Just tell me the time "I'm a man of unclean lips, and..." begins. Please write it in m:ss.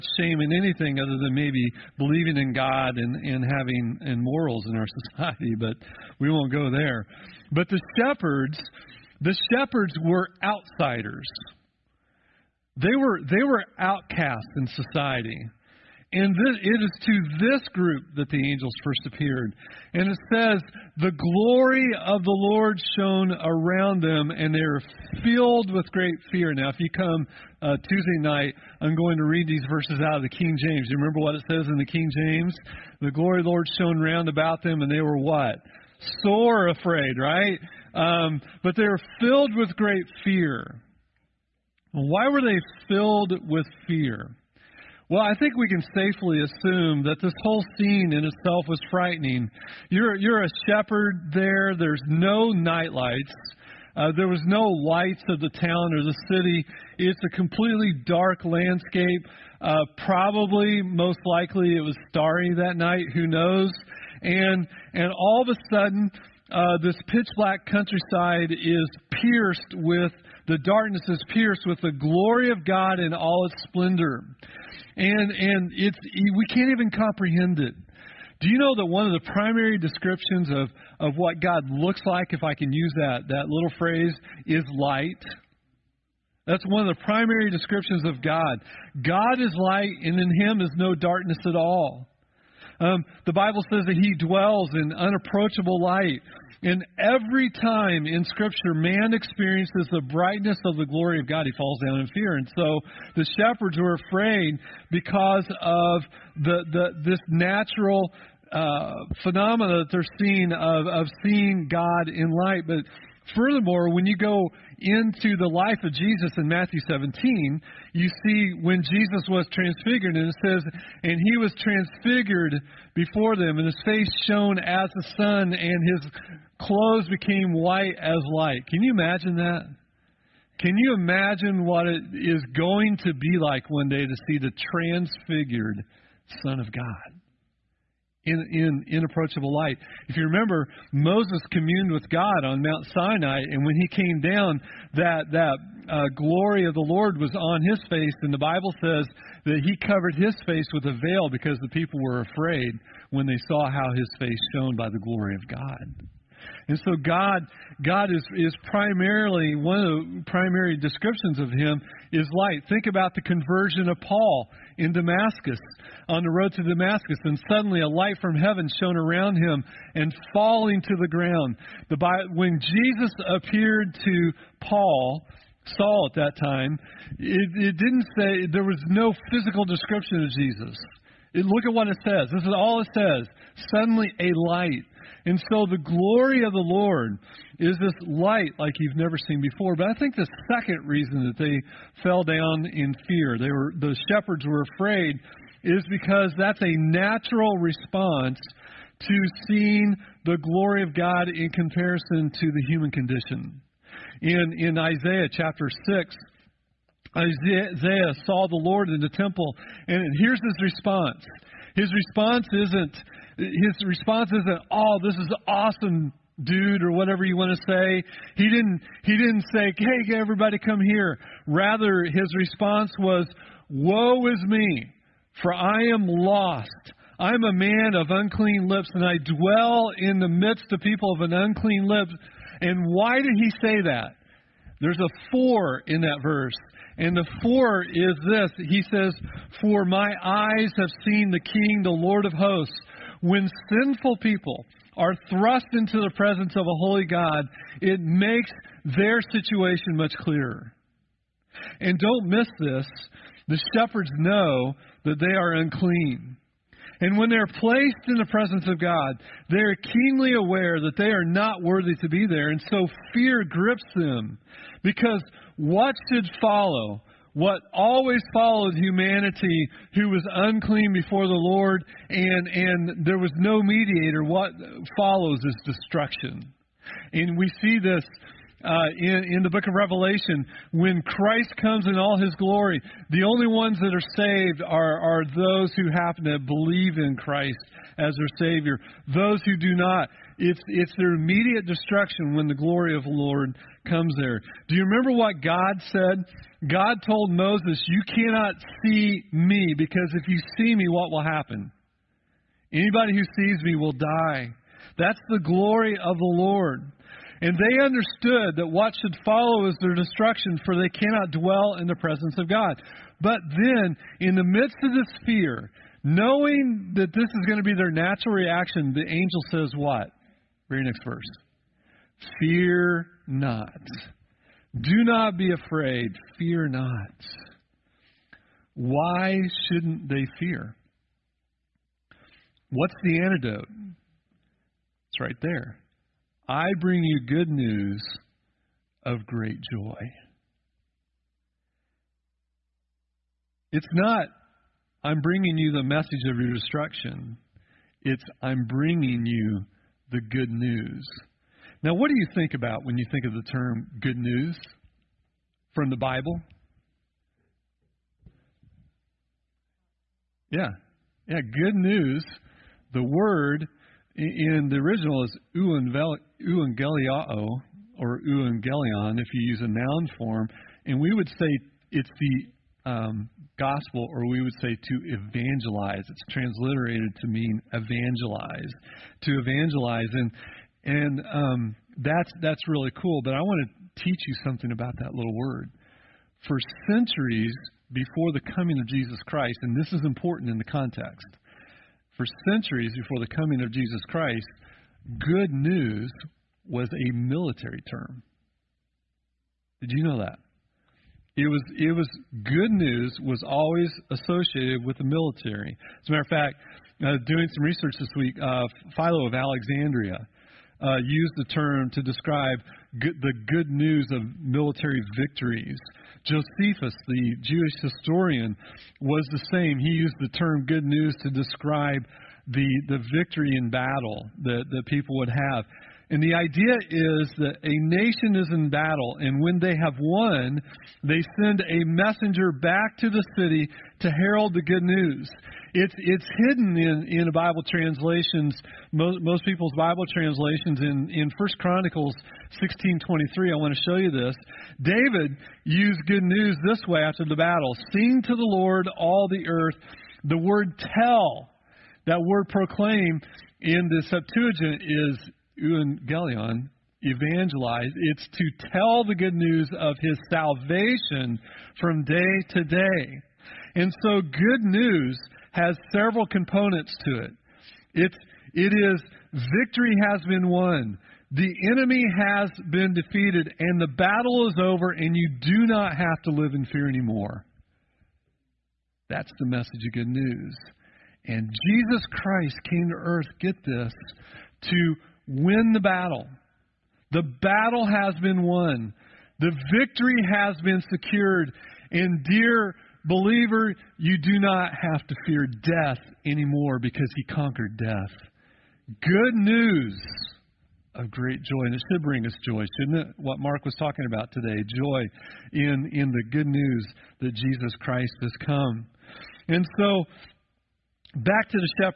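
3:47.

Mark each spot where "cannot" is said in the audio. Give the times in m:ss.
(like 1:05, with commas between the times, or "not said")
4:58, 5:10.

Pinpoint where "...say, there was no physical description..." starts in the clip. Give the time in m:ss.
2:58.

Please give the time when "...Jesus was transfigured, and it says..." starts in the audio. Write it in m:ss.
1:58.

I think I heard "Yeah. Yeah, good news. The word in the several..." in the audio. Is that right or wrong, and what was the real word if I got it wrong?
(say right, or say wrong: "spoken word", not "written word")
wrong: "original", not "several".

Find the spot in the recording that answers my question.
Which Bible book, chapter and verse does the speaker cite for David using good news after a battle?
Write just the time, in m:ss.
7:21.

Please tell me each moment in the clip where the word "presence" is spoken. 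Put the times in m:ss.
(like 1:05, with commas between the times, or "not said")
4:06, 4:18, 5:11.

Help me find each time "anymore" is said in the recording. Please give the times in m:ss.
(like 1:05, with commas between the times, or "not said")
7:56, 8:16.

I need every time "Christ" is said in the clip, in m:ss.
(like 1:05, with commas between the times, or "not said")
4:41, 4:47, 6:29, 6:34, 8:02, 8:27.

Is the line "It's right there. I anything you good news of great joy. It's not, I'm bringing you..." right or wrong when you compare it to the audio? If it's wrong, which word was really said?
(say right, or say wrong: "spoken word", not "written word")
wrong: "bring", not "anything".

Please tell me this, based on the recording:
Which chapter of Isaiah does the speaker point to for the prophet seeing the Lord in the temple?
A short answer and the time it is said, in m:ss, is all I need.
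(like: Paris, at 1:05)
Chapter 6, at 3:24.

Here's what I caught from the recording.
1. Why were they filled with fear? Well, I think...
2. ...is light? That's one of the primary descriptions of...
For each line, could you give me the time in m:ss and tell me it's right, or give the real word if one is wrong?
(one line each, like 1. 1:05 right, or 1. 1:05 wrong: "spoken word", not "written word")
1. 0:41 right
2. 1:24 right.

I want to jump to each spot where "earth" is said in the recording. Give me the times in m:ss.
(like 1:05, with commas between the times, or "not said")
7:29, 8:02.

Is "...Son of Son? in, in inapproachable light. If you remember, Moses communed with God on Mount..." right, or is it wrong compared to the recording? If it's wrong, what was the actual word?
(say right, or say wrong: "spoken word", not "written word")
wrong: "God", not "Son".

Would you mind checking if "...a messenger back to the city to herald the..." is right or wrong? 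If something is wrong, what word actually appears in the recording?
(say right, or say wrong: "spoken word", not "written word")
right.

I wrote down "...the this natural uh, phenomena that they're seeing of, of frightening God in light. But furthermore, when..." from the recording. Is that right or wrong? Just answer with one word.
wrong.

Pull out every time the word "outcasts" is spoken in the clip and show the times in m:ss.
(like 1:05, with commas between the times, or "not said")
0:13.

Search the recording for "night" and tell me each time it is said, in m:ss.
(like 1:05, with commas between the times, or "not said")
0:28, 0:52, 1:02.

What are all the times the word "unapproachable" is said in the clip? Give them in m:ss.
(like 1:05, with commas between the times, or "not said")
1:34.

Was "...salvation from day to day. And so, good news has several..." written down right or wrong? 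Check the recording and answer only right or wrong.
right.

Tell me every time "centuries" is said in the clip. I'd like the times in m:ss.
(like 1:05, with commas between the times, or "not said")
6:26, 6:32.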